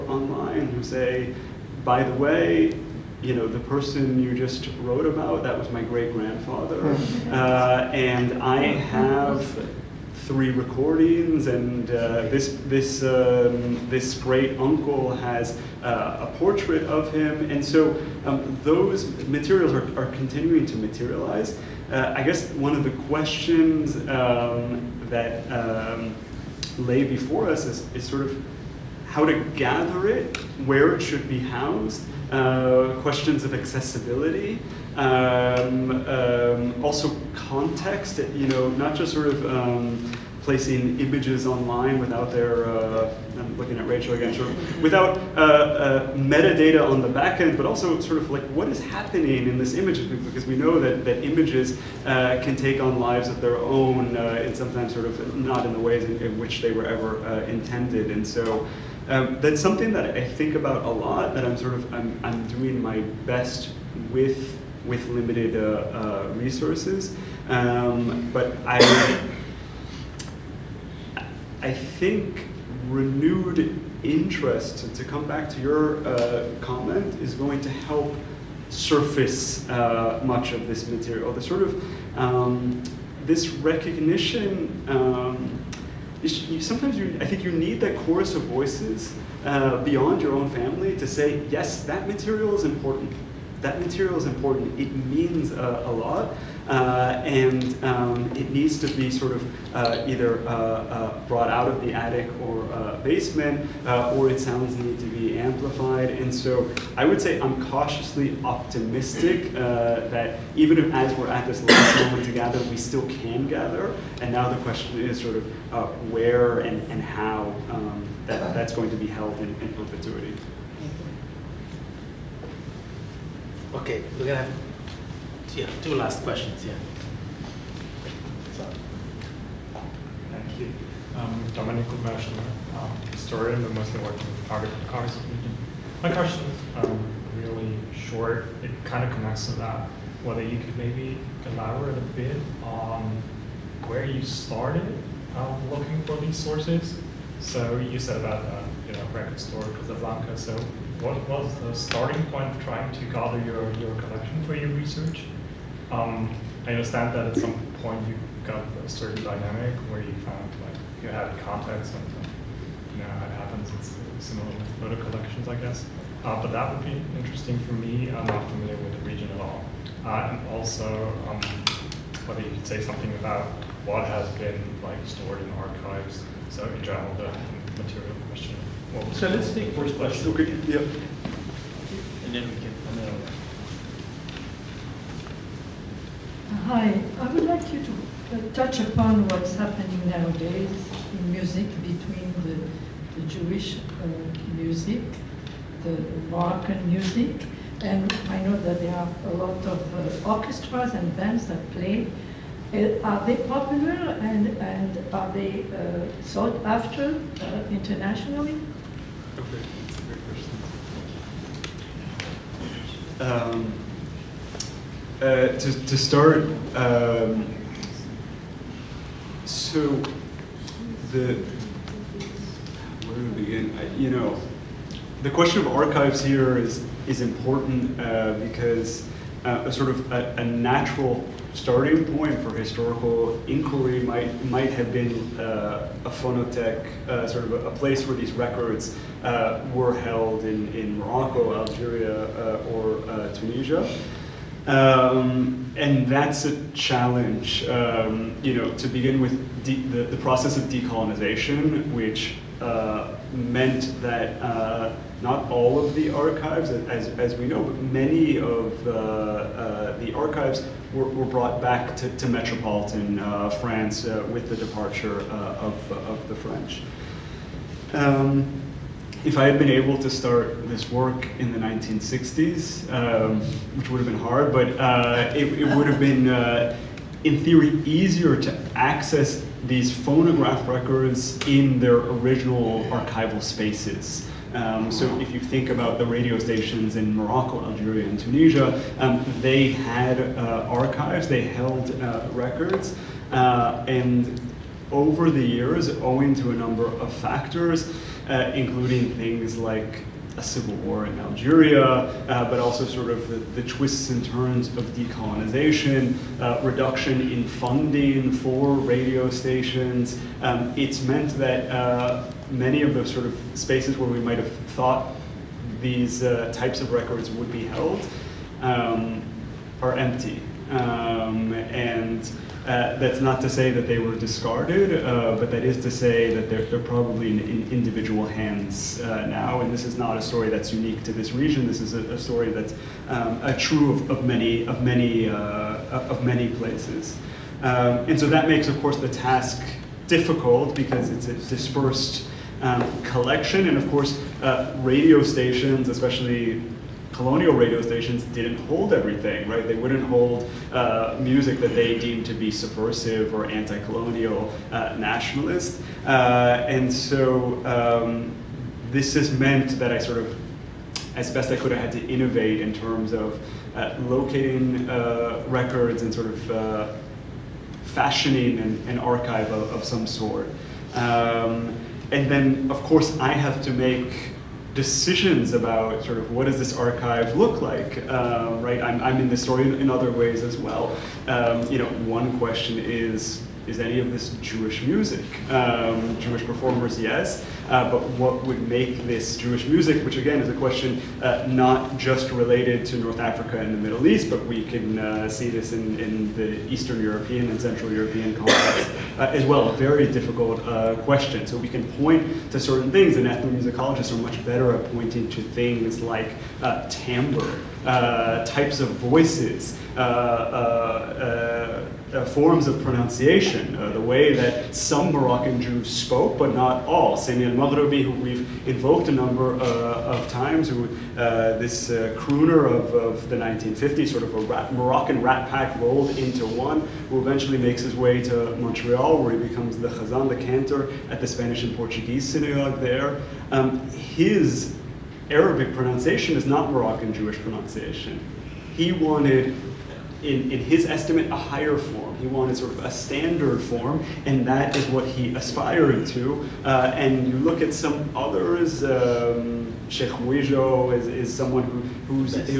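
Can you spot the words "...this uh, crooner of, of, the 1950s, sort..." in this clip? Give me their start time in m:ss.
7:01.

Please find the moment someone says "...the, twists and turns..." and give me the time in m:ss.
5:03.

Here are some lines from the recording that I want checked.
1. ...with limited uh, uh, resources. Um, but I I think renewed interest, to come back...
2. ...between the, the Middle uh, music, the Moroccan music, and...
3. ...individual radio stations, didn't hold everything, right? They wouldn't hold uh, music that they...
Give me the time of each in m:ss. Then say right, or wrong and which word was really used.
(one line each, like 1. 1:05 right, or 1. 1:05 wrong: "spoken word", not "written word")
1. 1:04 right
2. 3:11 wrong: "Jewish", not "Middle"
3. 5:47 wrong: "colonial", not "individual".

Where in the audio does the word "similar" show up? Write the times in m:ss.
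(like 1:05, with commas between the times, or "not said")
2:44.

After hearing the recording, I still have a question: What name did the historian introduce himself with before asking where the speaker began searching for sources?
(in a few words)
Dominic Kubashner.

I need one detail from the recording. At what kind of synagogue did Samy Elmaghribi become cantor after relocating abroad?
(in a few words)
Spanish and Portuguese synagogue.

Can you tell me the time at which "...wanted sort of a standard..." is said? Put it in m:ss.
7:22.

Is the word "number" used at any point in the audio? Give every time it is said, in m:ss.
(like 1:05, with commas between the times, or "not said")
4:56, 6:59.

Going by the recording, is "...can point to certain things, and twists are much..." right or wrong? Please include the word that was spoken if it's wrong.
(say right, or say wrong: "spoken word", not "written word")
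wrong: "ethnomusicologists", not "twists".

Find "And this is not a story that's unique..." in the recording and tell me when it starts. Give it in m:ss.
5:29.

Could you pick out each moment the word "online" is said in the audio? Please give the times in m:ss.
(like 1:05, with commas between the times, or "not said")
0:00, 0:41.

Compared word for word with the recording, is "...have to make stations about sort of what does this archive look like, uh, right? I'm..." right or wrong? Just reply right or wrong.
wrong.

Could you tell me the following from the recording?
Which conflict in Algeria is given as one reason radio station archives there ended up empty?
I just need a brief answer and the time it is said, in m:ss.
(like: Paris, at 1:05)
A civil war, at 5:00.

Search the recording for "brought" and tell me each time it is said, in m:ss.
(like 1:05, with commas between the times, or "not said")
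1:41, 4:21.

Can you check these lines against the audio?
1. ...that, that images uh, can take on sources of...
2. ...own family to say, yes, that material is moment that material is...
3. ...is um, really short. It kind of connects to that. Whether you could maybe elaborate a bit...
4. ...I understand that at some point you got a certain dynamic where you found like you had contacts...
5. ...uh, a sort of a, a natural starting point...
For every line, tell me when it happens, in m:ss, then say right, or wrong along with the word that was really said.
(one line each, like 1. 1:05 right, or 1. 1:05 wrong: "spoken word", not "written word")
1. 0:50 wrong: "lives", not "sources"
2. 1:30 wrong: "important", not "moment"
3. 2:16 right
4. 2:36 right
5. 3:49 right.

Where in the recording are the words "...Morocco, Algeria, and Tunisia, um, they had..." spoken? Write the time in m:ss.
4:47.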